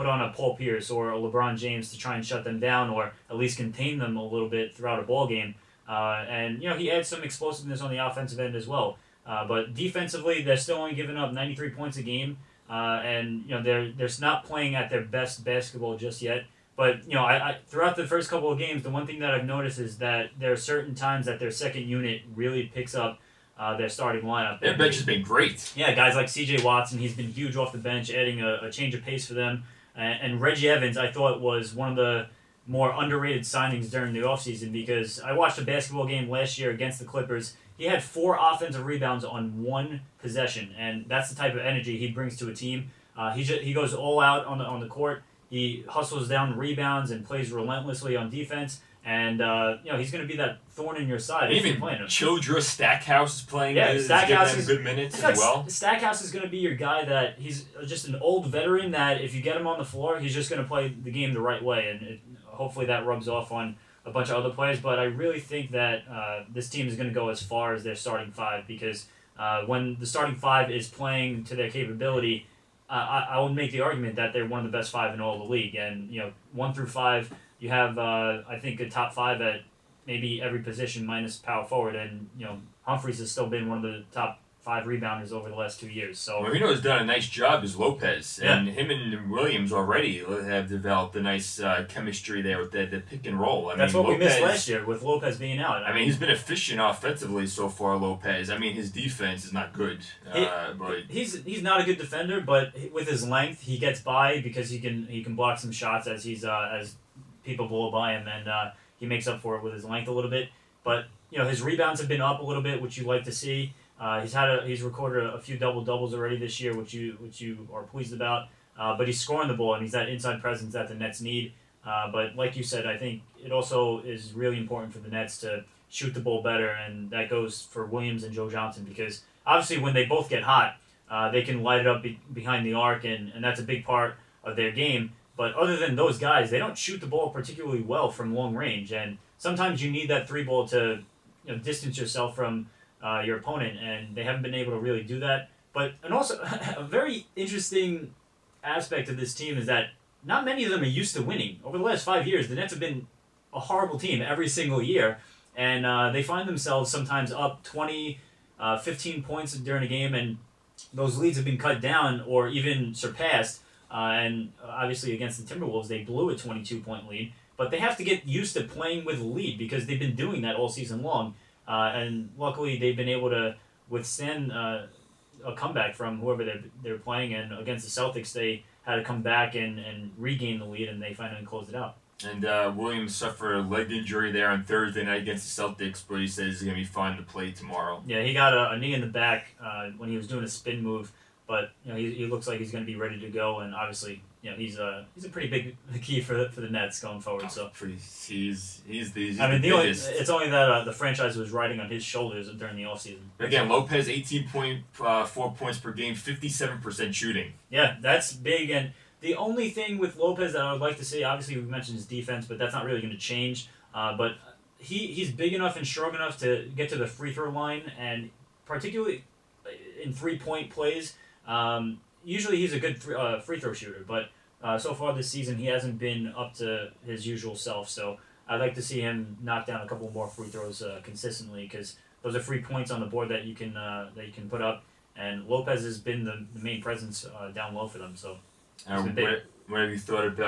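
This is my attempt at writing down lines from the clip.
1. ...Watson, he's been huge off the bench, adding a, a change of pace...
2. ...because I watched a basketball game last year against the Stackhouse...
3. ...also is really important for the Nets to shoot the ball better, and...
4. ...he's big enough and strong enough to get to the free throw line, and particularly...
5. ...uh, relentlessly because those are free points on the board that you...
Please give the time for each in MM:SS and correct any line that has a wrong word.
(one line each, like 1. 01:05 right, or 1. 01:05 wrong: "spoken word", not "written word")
1. 00:26 right
2. 00:34 wrong: "Clippers", not "Stackhouse"
3. 02:03 right
4. 03:35 right
5. 03:50 wrong: "consistently", not "relentlessly".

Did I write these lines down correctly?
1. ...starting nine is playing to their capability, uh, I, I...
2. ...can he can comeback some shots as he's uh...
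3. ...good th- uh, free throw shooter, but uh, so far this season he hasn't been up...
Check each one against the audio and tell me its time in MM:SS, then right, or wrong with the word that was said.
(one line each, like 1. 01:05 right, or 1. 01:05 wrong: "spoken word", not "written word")
1. 01:10 wrong: "five", not "nine"
2. 01:44 wrong: "block", not "comeback"
3. 03:42 right.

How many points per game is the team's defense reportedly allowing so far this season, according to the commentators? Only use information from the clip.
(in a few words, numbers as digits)
93.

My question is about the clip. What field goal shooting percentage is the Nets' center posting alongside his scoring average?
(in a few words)
57%.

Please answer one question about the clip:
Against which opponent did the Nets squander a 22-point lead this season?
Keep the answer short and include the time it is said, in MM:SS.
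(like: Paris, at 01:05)
Timberwolves, at 02:45.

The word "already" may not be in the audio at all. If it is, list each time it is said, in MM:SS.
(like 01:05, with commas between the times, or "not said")
01:29, 01:56.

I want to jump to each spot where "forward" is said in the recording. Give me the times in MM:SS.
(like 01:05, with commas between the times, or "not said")
01:21, 03:17.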